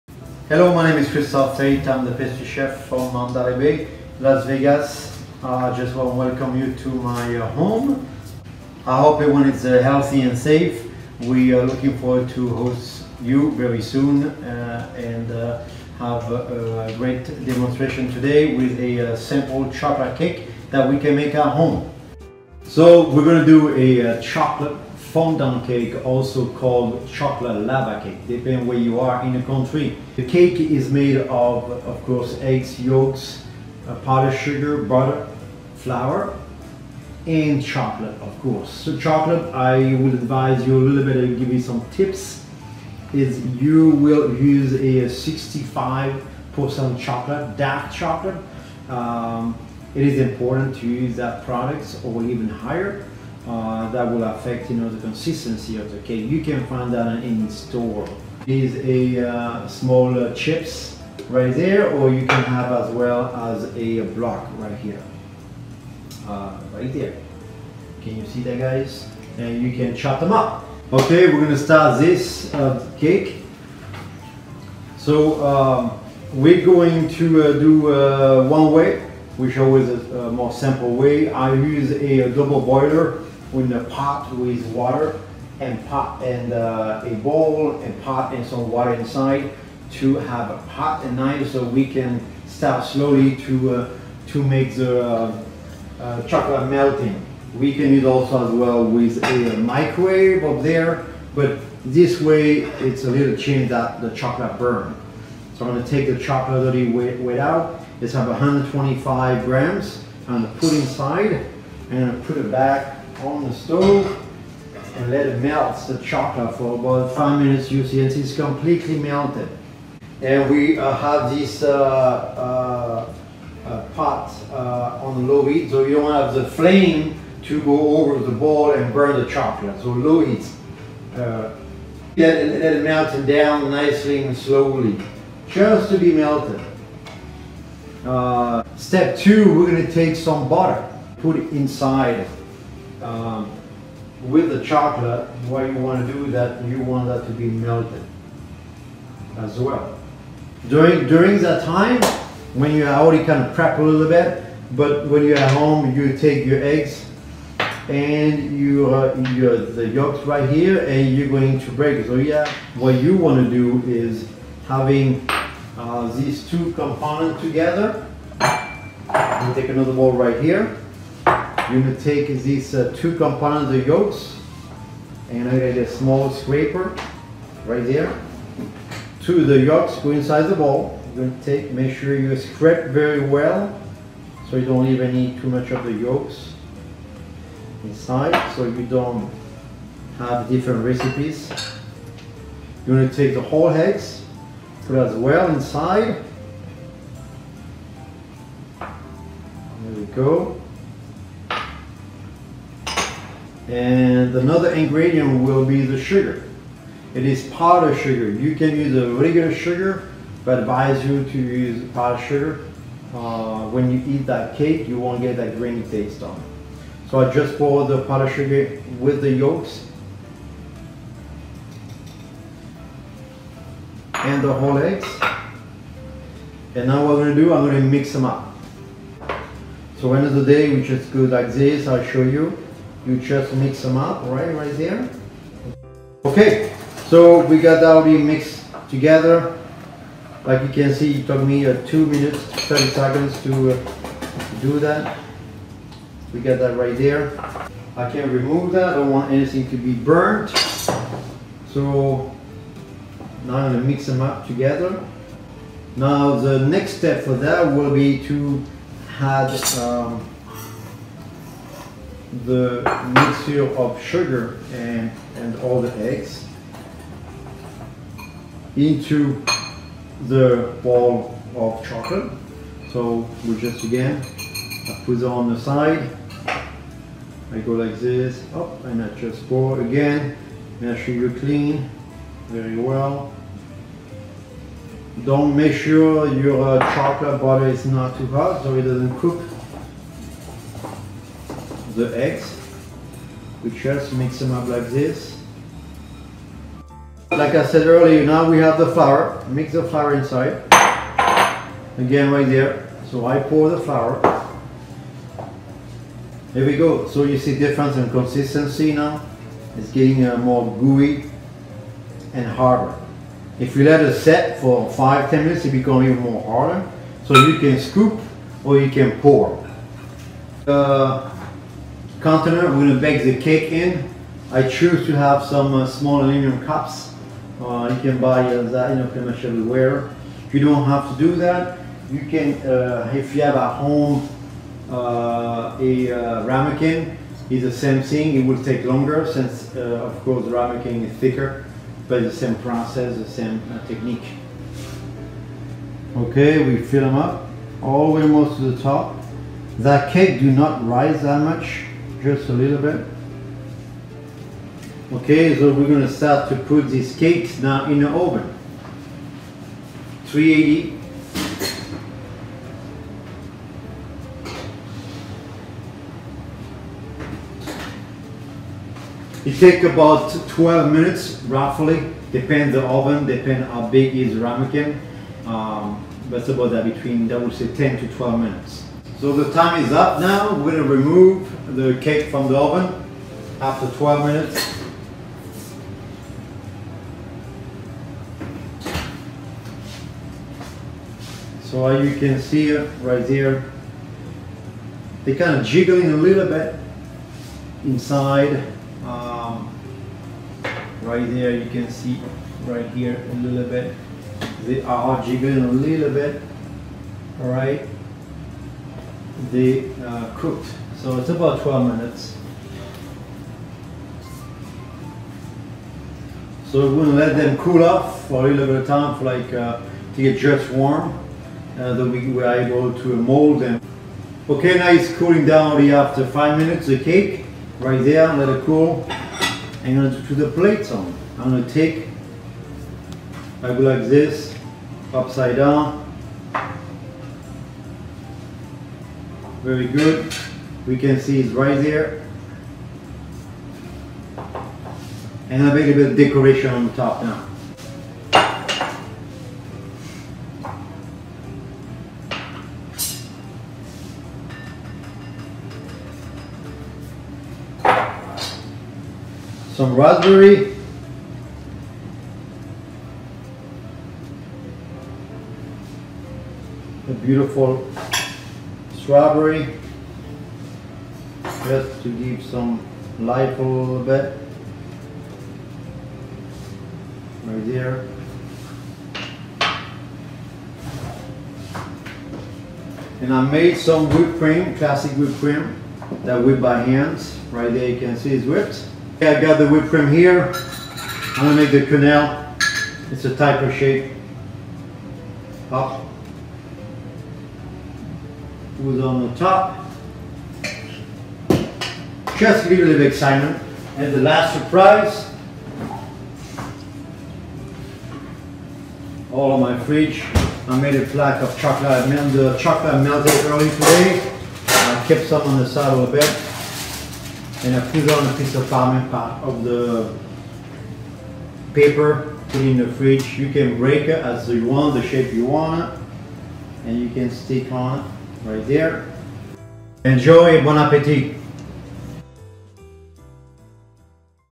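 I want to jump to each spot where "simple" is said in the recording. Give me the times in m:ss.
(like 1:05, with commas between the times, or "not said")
0:19, 1:20.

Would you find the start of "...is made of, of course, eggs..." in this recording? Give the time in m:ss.
0:30.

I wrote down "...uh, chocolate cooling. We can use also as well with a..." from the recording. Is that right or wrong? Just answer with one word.
wrong.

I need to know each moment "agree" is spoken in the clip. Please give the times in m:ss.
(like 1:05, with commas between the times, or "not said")
not said.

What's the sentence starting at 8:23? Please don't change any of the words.
And the last surprise, all of my fridge.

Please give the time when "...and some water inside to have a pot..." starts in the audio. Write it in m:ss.
1:28.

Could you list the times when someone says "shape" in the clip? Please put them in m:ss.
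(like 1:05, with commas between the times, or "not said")
8:13, 8:45.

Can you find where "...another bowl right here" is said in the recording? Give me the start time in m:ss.
2:49.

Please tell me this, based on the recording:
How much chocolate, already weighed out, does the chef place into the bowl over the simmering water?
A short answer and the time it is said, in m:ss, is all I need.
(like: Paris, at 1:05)
125 grams, at 1:48.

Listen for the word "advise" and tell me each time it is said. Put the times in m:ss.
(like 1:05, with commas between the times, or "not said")
0:40, 3:30.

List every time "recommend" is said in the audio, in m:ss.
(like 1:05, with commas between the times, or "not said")
not said.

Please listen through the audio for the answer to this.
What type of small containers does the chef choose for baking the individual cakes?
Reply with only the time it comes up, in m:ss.
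5:26.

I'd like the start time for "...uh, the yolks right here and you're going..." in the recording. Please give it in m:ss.
2:38.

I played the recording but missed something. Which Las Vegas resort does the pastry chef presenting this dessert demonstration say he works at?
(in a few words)
Mandalay Bay.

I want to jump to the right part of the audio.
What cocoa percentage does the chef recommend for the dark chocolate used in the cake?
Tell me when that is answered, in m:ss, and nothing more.
0:45.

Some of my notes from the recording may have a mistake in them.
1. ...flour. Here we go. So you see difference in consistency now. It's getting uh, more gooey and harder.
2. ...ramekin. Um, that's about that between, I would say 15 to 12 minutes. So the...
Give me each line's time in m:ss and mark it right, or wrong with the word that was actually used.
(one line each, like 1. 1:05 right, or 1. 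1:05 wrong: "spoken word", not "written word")
1. 5:03 right
2. 6:14 wrong: "10", not "15".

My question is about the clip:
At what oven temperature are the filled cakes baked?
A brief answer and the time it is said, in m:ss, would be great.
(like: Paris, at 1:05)
380, at 6:00.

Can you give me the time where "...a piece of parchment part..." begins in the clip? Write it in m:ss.
8:38.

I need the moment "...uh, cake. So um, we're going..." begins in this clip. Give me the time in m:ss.
1:12.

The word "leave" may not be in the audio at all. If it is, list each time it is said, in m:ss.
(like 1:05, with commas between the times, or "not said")
3:04, 8:22.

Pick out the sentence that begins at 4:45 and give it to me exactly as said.
Don't make sure your uh, chocolate butter is not too hot so it doesn't cook the eggs.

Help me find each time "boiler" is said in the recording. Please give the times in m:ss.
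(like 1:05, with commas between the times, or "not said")
1:22.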